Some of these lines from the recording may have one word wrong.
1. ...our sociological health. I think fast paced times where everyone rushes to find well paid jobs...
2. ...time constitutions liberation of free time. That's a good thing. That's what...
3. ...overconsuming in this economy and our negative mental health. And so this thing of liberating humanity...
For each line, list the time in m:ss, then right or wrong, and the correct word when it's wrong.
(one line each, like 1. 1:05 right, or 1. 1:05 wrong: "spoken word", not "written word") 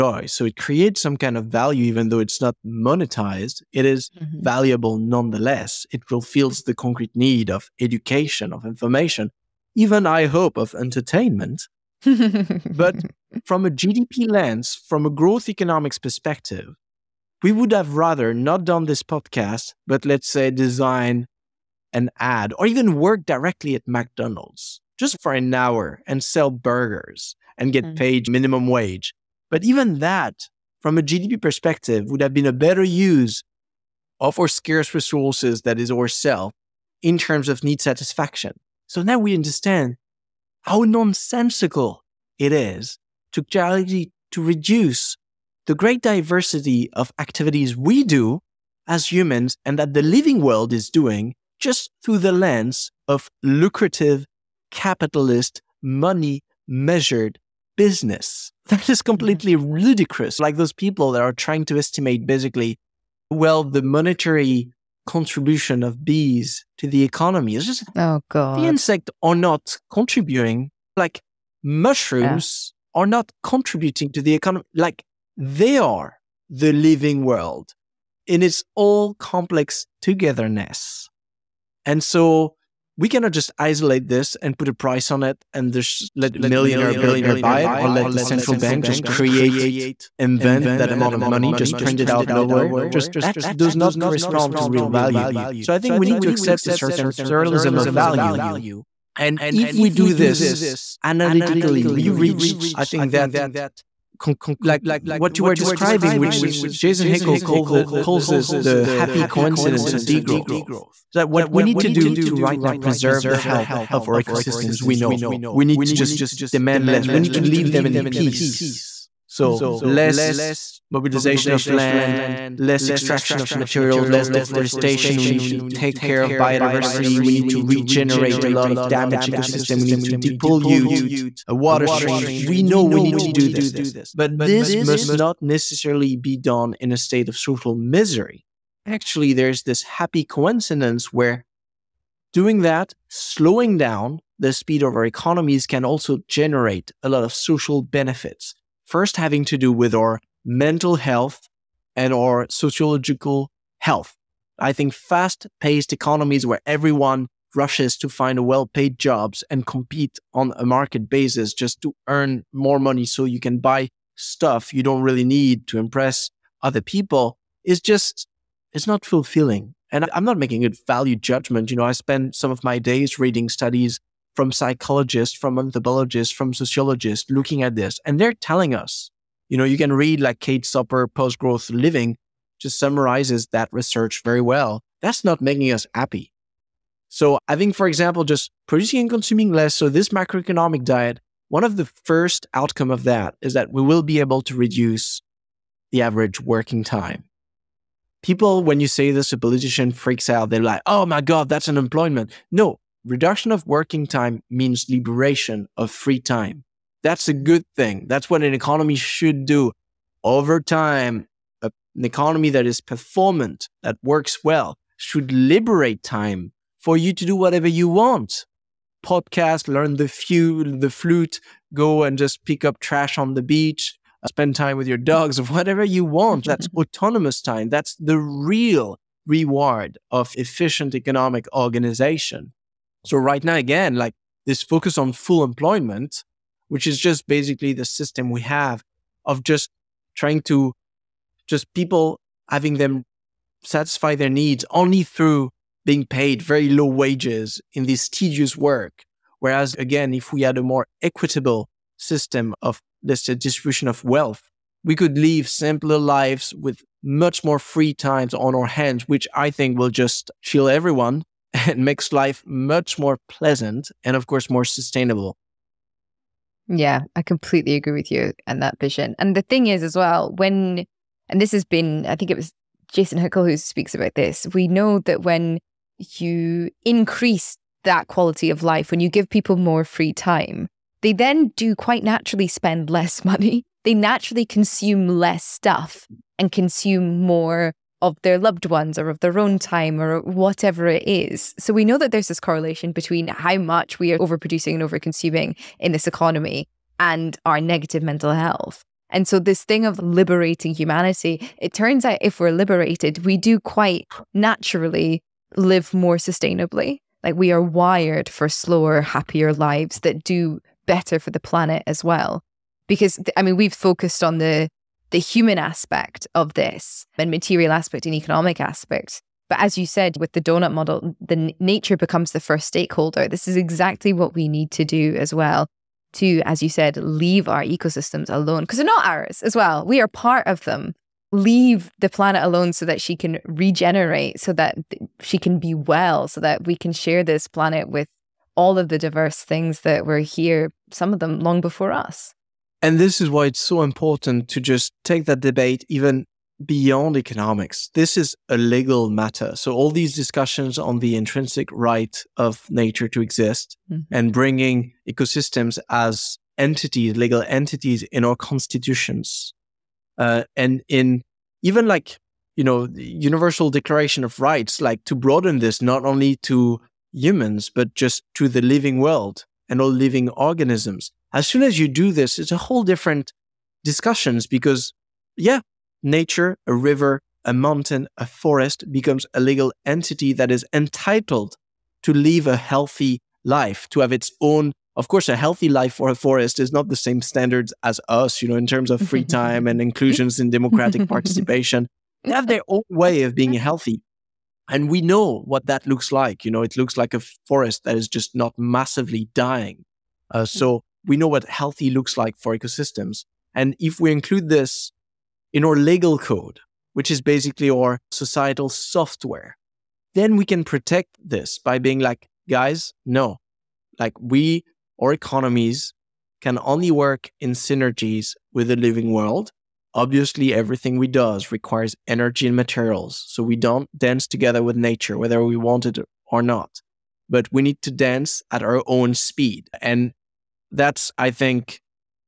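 1. 2:32 wrong: "economies", not "times"
2. 3:24 wrong: "means", not "constitutions"
3. 4:54 right.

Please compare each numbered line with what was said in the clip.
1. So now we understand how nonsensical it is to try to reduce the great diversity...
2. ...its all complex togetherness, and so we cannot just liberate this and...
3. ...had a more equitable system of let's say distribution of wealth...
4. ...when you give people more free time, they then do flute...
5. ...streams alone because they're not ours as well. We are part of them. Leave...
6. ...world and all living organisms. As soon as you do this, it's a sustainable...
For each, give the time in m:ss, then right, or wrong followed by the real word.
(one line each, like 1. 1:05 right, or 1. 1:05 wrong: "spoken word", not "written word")
1. 0:38 right
2. 1:18 wrong: "isolate", not "liberate"
3. 4:10 right
4. 4:38 wrong: "quite", not "flute"
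5. 5:27 wrong: "ecosystems", not "streams"
6. 6:08 wrong: "whole", not "sustainable".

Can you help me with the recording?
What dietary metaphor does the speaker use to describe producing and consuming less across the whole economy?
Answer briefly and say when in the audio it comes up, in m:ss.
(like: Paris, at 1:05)
Macroeconomic diet, at 3:10.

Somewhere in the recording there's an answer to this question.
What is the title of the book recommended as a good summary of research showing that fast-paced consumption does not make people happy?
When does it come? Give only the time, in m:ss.
3:01.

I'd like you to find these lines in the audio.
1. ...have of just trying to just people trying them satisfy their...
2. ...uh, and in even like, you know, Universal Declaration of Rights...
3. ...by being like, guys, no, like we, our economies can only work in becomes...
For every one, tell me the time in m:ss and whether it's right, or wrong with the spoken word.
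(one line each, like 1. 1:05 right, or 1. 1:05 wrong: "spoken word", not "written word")
1. 3:58 wrong: "having", not "trying"
2. 6:00 right
3. 6:51 wrong: "synergies", not "becomes".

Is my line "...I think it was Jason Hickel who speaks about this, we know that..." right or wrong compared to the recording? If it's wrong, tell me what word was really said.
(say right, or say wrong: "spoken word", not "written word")
right.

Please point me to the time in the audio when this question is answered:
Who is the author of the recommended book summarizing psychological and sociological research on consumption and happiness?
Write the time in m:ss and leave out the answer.
3:00.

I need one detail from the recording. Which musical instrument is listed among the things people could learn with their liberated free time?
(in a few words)
The flute.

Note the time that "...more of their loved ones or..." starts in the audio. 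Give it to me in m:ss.
4:47.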